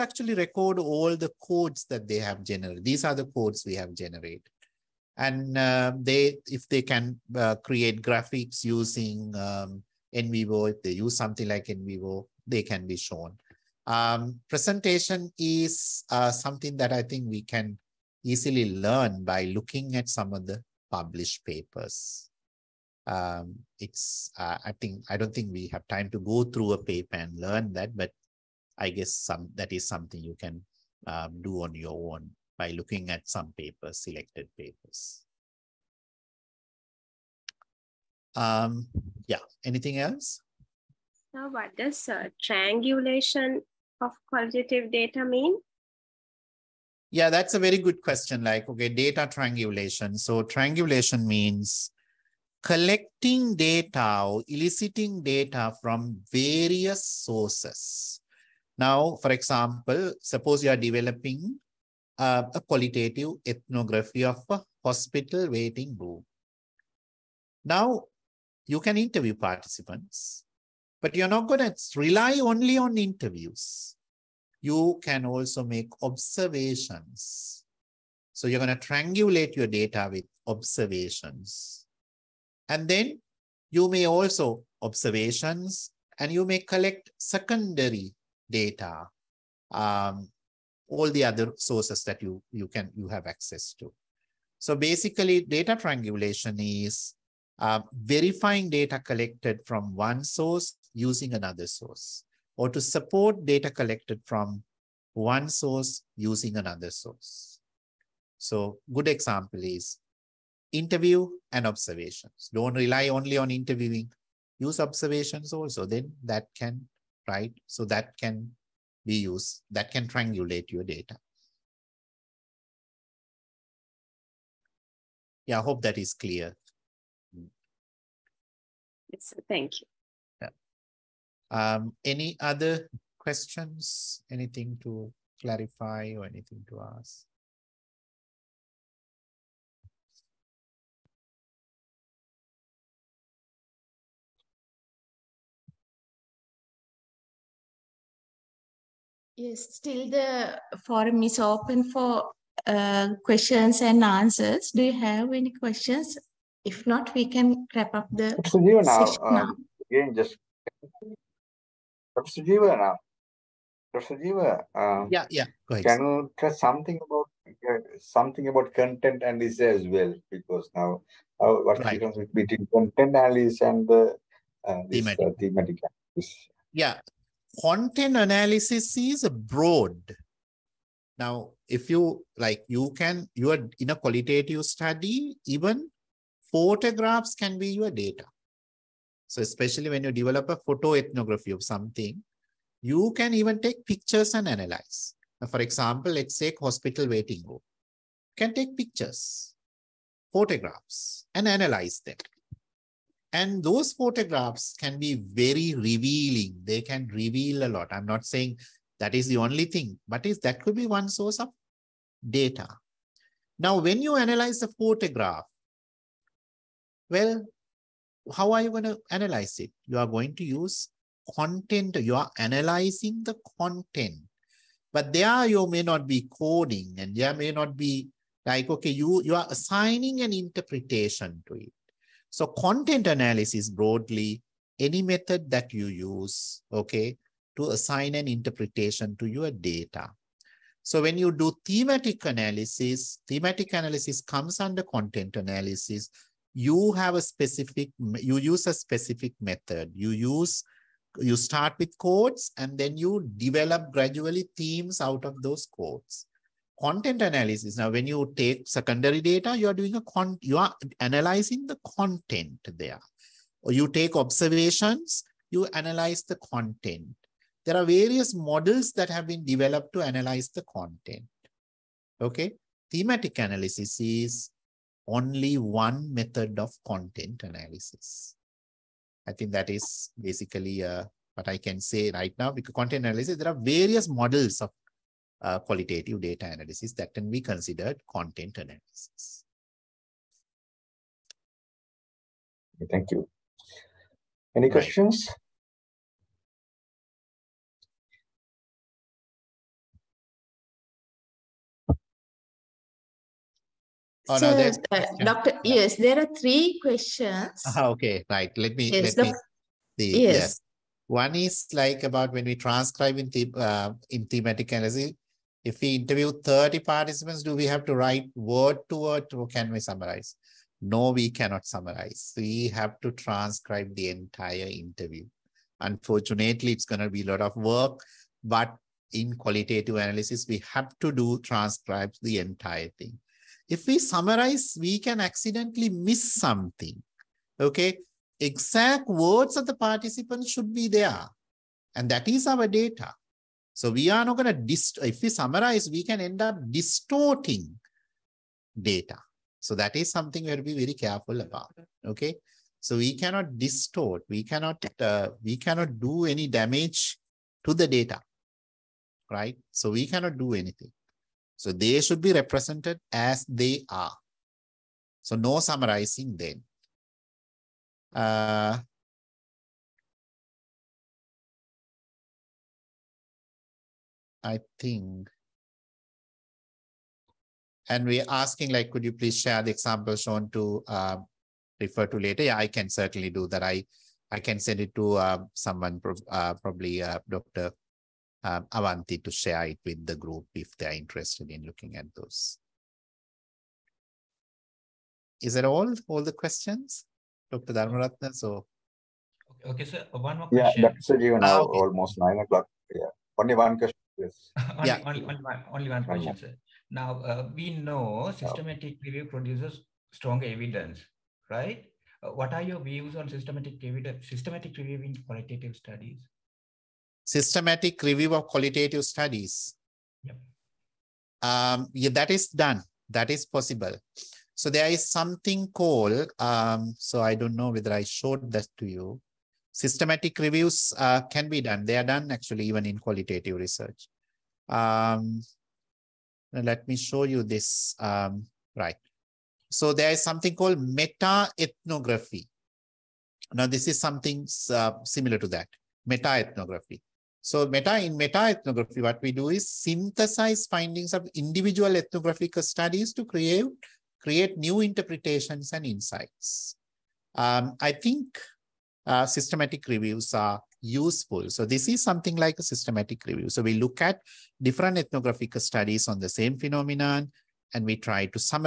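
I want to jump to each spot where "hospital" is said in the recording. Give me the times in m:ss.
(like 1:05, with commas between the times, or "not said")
1:04, 3:16.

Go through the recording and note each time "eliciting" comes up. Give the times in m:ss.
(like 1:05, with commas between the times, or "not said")
0:54.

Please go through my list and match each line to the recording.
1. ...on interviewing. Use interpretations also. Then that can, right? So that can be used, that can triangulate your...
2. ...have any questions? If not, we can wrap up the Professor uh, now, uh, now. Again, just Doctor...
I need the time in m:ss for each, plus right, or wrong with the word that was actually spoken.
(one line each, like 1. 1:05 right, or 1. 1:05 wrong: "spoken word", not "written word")
1. 1:53 wrong: "observations", not "interpretations"
2. 2:34 wrong: "Professor", not "Doctor".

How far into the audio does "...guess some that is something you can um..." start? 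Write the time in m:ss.
0:28.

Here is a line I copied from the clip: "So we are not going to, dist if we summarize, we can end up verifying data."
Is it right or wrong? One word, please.
wrong.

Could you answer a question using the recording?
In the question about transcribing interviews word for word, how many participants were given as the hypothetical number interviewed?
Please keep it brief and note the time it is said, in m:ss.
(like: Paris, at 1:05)
30, at 5:16.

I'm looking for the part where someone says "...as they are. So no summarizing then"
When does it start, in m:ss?
6:03.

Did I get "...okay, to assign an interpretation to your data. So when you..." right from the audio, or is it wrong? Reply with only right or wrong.
right.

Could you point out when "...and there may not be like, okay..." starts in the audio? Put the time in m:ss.
3:46.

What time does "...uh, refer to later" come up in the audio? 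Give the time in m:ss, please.
6:20.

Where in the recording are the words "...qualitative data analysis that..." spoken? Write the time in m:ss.
4:45.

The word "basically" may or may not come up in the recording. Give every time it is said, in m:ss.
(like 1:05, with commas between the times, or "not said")
1:34, 4:40.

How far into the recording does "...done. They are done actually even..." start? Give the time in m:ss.
7:11.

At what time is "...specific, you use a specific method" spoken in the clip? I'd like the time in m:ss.
4:07.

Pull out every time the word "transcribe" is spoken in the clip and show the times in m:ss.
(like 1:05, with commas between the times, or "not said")
5:12, 5:23, 5:31.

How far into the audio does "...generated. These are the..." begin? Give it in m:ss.
0:02.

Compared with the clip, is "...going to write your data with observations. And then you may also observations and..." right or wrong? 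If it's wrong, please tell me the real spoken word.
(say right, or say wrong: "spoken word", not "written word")
wrong: "triangulate", not "write".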